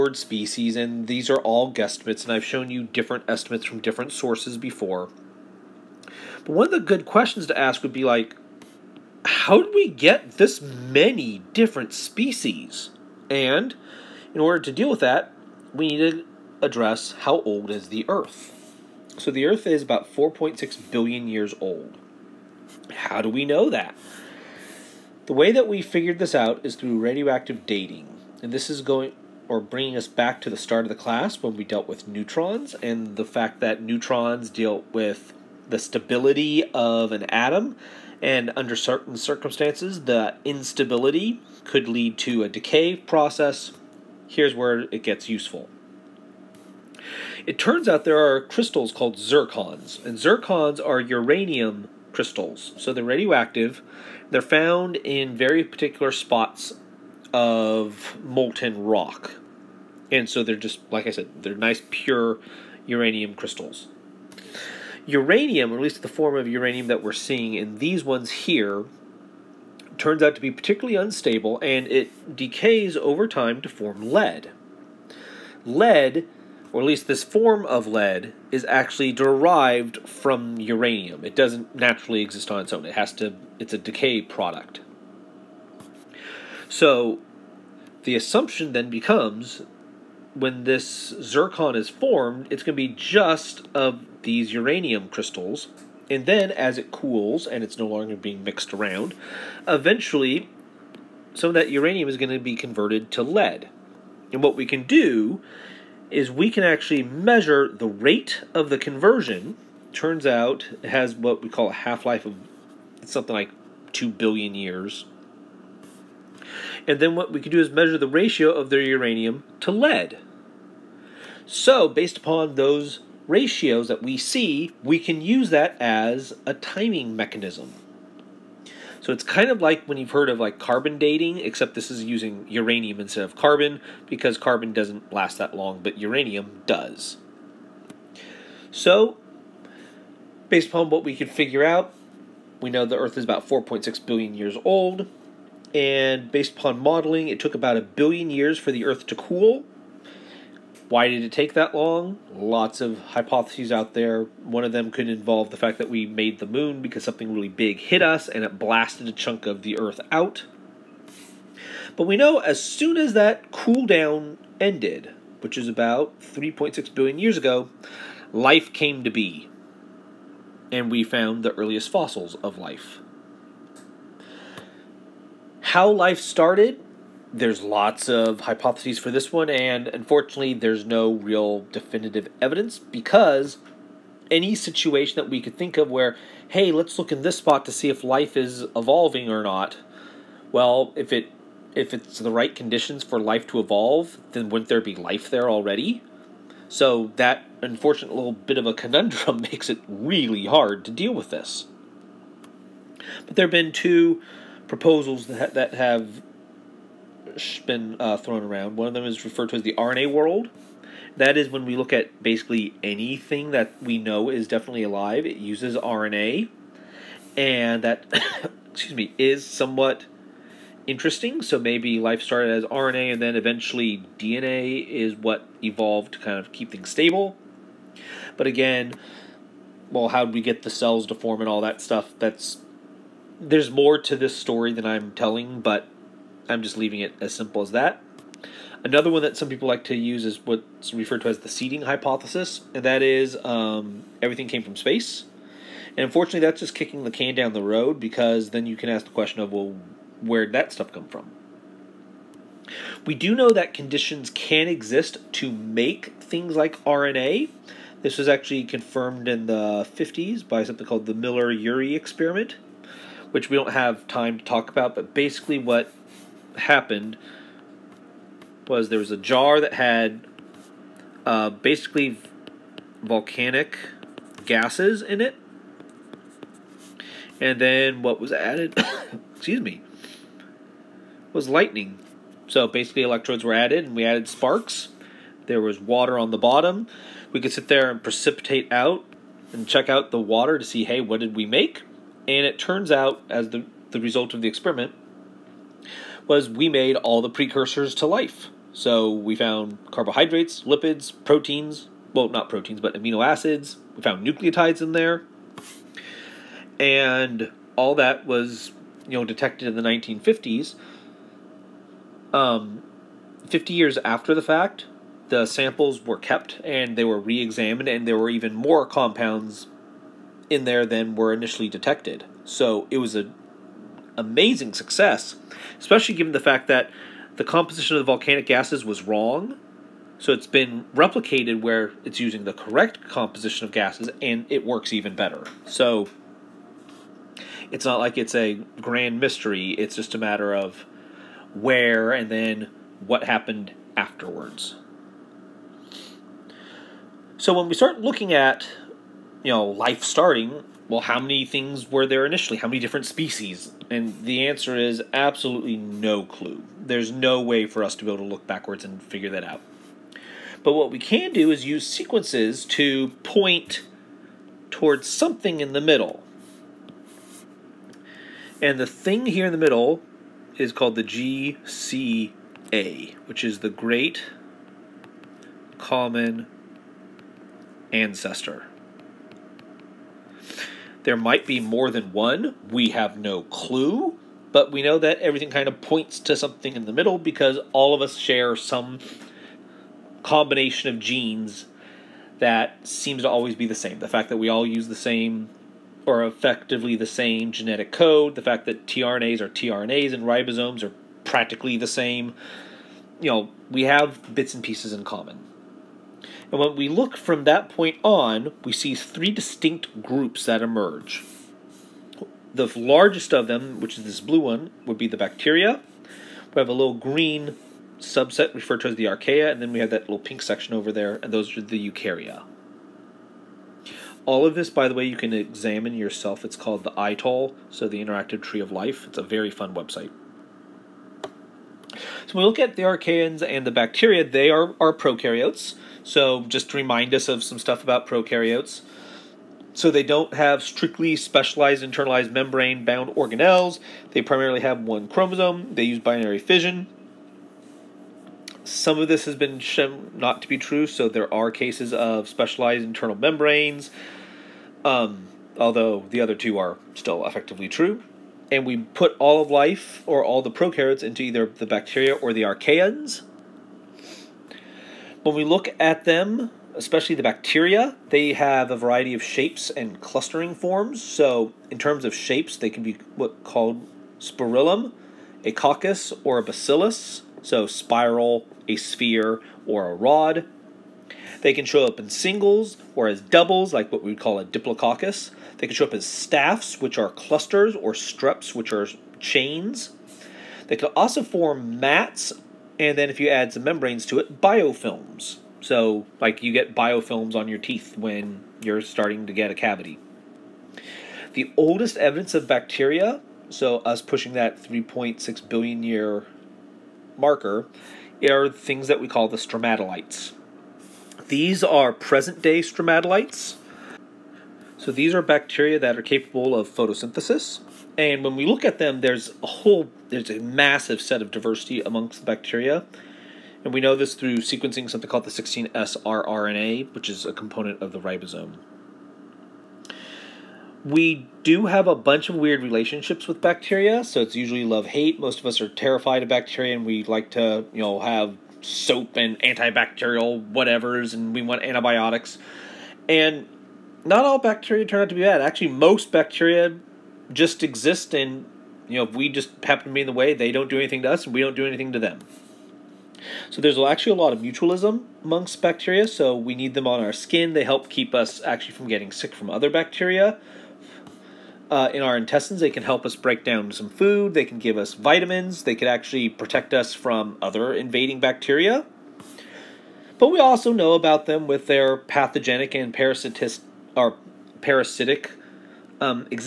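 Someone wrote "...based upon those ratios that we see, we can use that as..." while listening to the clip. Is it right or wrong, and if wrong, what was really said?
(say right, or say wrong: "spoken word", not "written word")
right.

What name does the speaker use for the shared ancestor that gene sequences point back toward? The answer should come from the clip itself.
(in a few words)
Great Common Ancestor.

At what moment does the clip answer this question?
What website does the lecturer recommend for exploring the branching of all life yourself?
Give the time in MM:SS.
07:08.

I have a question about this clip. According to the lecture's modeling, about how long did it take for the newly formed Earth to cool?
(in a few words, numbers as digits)
about a billion years.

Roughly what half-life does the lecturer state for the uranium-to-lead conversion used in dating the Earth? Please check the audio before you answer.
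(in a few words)
2 billion years.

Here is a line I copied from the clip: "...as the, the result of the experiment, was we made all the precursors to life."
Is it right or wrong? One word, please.
right.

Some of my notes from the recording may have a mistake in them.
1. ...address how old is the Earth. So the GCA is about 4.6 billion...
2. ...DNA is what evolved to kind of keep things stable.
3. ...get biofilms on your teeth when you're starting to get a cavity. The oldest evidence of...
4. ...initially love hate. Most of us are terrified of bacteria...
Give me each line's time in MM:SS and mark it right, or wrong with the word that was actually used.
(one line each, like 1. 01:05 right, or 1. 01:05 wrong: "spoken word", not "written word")
1. 00:16 wrong: "Earth", not "GCA"
2. 03:44 right
3. 08:16 right
4. 08:54 wrong: "usually", not "initially".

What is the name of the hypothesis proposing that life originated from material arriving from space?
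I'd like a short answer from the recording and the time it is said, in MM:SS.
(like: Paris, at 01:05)
seeding hypothesis, at 04:01.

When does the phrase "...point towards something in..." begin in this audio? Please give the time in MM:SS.
06:03.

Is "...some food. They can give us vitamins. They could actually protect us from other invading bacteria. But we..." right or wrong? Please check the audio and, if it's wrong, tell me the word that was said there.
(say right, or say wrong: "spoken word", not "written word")
right.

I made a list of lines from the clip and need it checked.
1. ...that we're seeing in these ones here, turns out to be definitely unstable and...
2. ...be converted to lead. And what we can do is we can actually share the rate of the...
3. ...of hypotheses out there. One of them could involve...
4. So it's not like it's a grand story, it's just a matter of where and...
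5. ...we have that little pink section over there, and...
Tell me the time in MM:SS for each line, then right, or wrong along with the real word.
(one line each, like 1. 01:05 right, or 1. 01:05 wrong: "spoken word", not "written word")
1. 01:06 wrong: "particularly", not "definitely"
2. 01:42 wrong: "measure", not "share"
3. 02:32 right
4. 05:35 wrong: "mystery", not "story"
5. 06:59 right.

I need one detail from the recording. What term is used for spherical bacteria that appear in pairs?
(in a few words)
diplococcus.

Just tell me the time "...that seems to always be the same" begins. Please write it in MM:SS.
06:32.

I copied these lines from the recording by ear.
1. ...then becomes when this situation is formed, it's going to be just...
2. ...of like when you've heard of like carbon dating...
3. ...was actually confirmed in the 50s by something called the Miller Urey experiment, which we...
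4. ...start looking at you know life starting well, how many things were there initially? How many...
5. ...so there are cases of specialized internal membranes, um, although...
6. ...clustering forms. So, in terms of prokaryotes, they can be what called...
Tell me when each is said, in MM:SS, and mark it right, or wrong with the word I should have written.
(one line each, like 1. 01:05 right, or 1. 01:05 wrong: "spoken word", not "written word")
1. 01:28 wrong: "zircon", not "situation"
2. 02:09 right
3. 04:18 right
4. 05:47 right
5. 07:30 right
6. 07:50 wrong: "shapes", not "prokaryotes".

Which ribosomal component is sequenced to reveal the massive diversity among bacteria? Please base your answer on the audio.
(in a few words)
16S rRNA.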